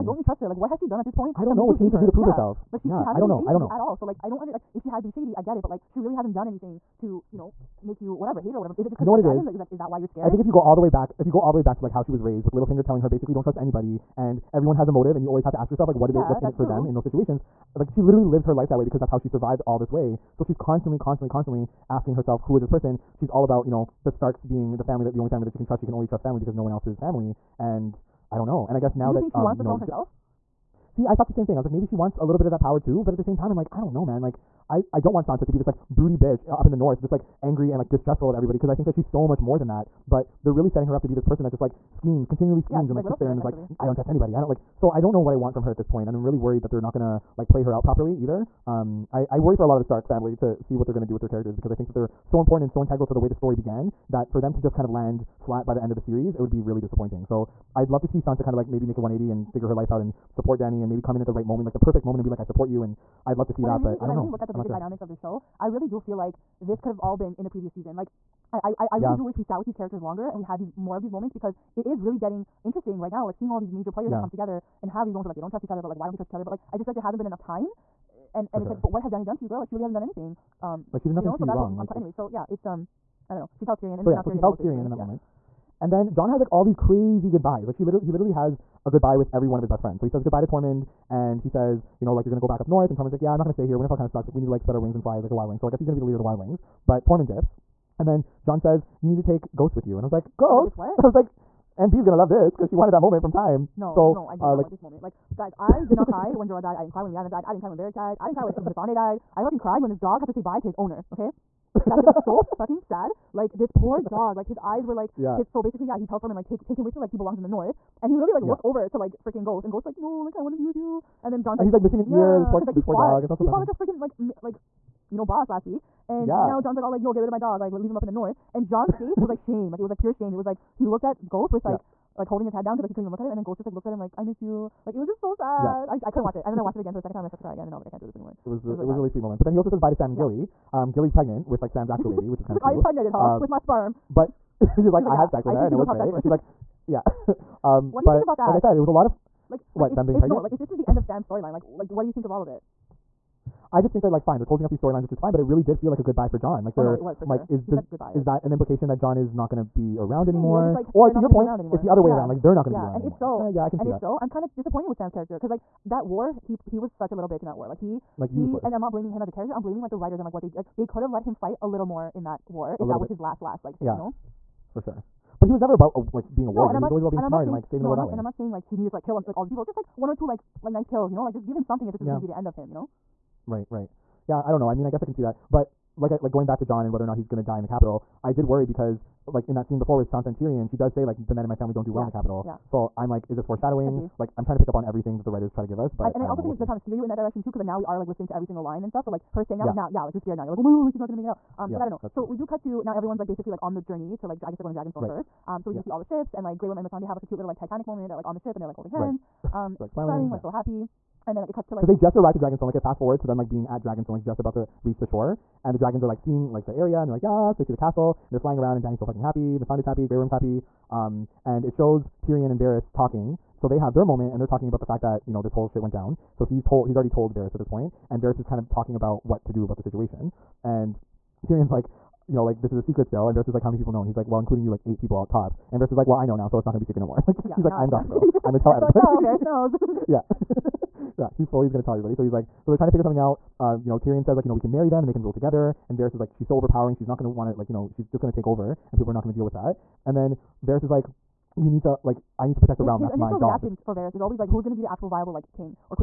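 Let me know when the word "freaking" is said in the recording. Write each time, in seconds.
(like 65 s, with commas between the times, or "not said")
119 s, 123 s.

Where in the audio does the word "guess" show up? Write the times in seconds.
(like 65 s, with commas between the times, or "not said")
28 s, 95 s, 184 s, 204 s.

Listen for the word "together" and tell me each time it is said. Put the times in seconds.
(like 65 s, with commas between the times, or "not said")
74 s, 245 s.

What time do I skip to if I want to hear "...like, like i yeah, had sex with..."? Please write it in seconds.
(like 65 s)
144 s.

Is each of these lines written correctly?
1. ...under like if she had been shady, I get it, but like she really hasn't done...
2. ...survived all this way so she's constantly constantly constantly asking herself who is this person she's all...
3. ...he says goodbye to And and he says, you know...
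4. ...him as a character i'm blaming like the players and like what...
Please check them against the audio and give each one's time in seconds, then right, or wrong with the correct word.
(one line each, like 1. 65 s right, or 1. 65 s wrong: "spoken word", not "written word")
1. 4 s right
2. 19 s right
3. 90 s wrong: "Tormund", not "And"
4. 169 s wrong: "writers", not "players".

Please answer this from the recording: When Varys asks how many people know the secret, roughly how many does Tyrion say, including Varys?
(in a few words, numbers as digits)
8.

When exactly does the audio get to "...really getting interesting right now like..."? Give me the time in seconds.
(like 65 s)
72 s.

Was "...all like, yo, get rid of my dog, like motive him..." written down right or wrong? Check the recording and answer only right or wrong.
wrong.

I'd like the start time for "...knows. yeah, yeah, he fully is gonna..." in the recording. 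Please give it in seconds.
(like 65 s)
239 s.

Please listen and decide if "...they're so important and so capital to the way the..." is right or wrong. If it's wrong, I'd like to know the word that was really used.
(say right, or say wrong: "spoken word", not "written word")
wrong: "integral", not "capital".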